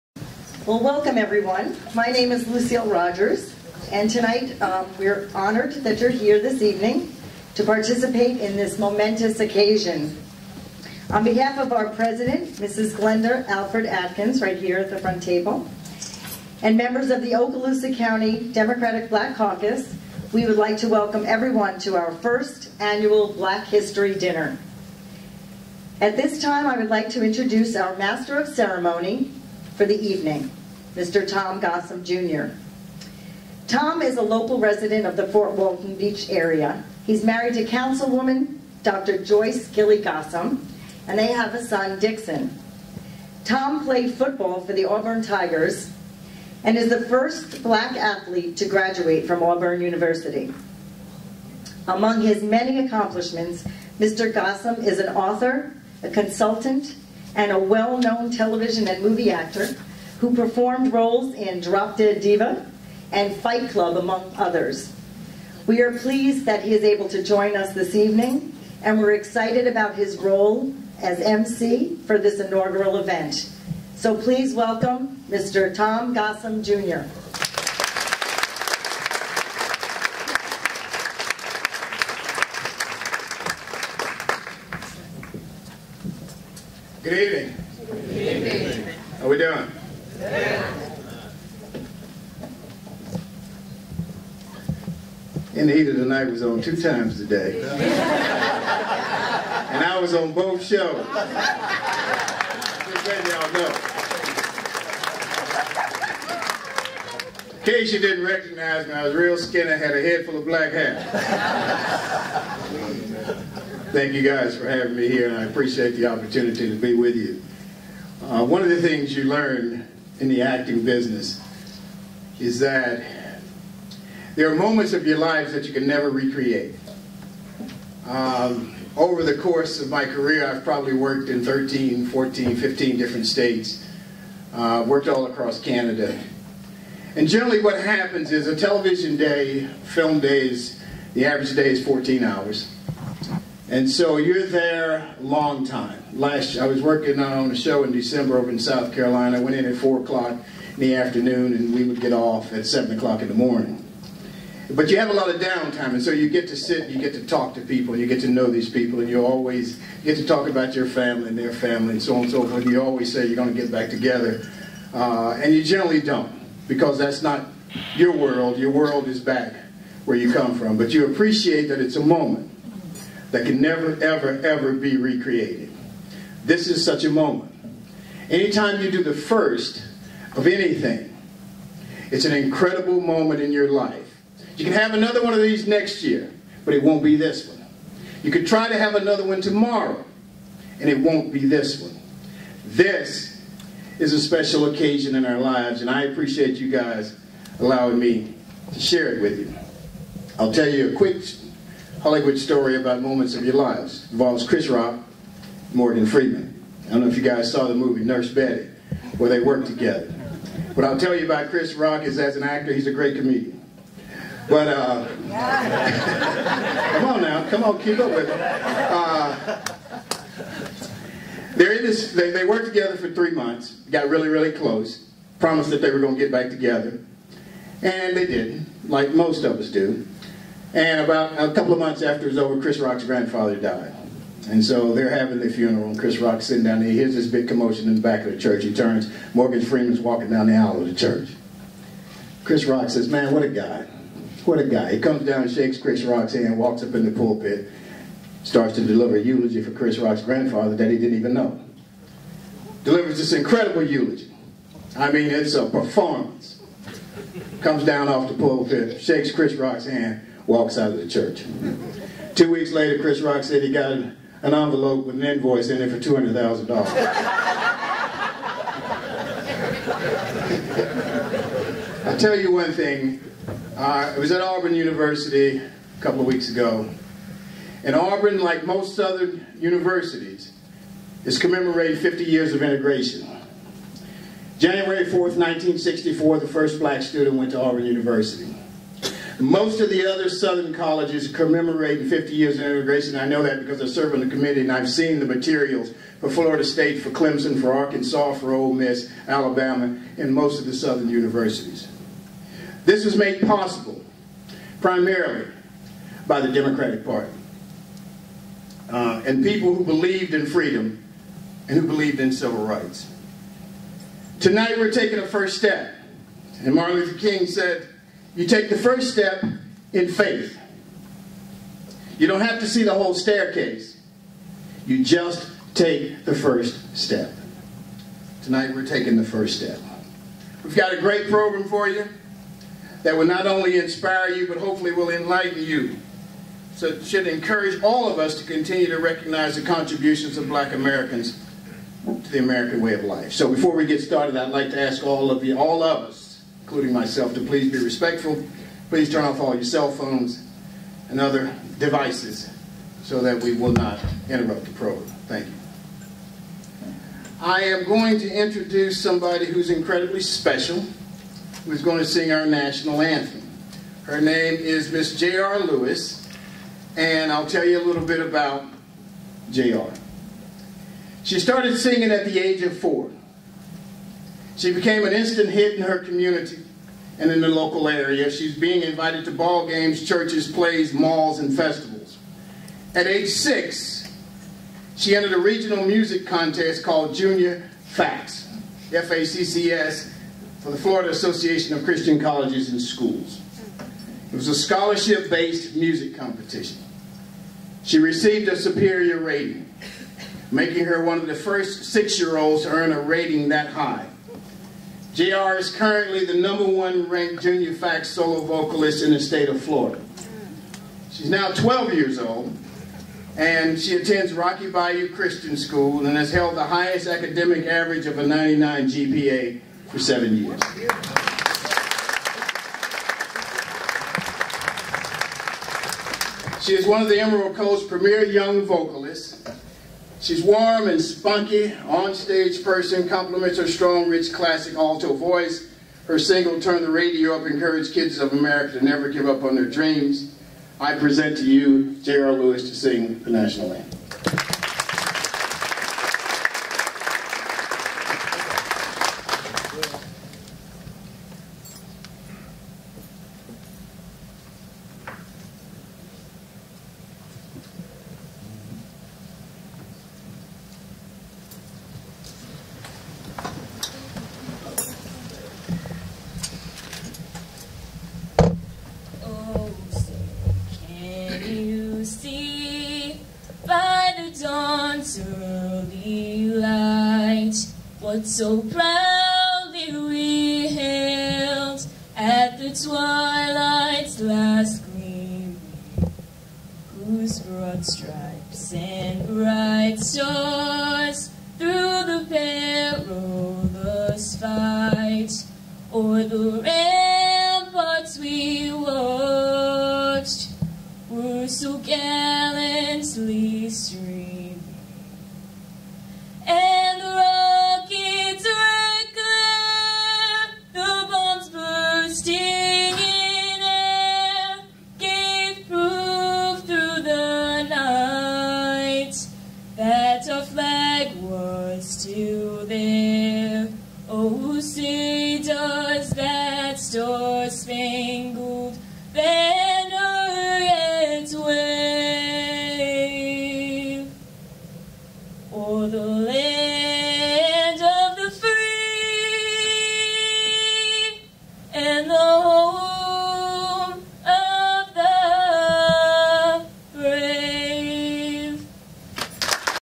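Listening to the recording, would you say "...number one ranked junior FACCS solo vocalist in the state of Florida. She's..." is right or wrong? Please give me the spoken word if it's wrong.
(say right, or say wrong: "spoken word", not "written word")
right.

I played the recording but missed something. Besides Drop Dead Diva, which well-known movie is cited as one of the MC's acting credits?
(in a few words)
Fight Club.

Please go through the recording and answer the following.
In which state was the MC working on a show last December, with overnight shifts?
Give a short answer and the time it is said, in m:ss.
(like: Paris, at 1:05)
South Carolina, at 2:28.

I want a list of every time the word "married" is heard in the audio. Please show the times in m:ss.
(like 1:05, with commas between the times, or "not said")
0:37.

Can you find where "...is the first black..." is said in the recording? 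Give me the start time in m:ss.
0:46.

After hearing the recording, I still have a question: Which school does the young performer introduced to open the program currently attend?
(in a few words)
Rocky Bayou Christian School.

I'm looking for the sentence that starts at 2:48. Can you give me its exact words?
Your world is back where you come from, but you appreciate that it's a moment that can never, ever, ever be recreated.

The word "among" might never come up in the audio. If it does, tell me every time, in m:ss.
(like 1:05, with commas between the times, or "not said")
0:51, 1:03.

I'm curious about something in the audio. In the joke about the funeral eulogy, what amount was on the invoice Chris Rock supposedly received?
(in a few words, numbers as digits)
$200,000.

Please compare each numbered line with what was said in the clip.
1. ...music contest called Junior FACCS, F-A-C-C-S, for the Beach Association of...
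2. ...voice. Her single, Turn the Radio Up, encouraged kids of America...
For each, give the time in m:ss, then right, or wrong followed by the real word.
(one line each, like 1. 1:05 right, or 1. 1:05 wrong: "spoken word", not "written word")
1. 6:25 wrong: "Florida", not "Beach"
2. 7:15 right.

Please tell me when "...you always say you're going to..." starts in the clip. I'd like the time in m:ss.
2:42.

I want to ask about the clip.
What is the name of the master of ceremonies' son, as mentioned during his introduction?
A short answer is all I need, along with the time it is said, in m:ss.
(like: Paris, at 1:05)
Dixon, at 0:41.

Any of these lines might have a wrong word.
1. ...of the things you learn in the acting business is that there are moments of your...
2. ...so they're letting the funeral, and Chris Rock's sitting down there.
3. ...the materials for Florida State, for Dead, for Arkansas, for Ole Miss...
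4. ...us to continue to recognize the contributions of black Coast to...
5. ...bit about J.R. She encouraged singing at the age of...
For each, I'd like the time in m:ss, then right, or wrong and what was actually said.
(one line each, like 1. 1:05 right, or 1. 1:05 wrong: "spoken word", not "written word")
1. 1:58 right
2. 3:54 wrong: "having", not "letting"
3. 4:55 wrong: "Clemson", not "Dead"
4. 5:38 wrong: "Americans", not "Coast"
5. 6:08 wrong: "started", not "encouraged".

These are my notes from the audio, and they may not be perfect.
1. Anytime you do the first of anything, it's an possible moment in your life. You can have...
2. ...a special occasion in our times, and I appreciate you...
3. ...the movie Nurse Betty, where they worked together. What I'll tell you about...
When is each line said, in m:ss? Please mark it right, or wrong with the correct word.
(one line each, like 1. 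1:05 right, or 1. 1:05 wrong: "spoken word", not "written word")
1. 2:58 wrong: "incredible", not "possible"
2. 3:14 wrong: "lives", not "times"
3. 3:27 right.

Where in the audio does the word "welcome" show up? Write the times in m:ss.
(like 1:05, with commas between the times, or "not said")
0:00, 0:20, 1:14.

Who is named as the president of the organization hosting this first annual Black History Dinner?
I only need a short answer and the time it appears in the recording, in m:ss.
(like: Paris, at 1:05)
Glenda Alfred Atkins, at 0:12.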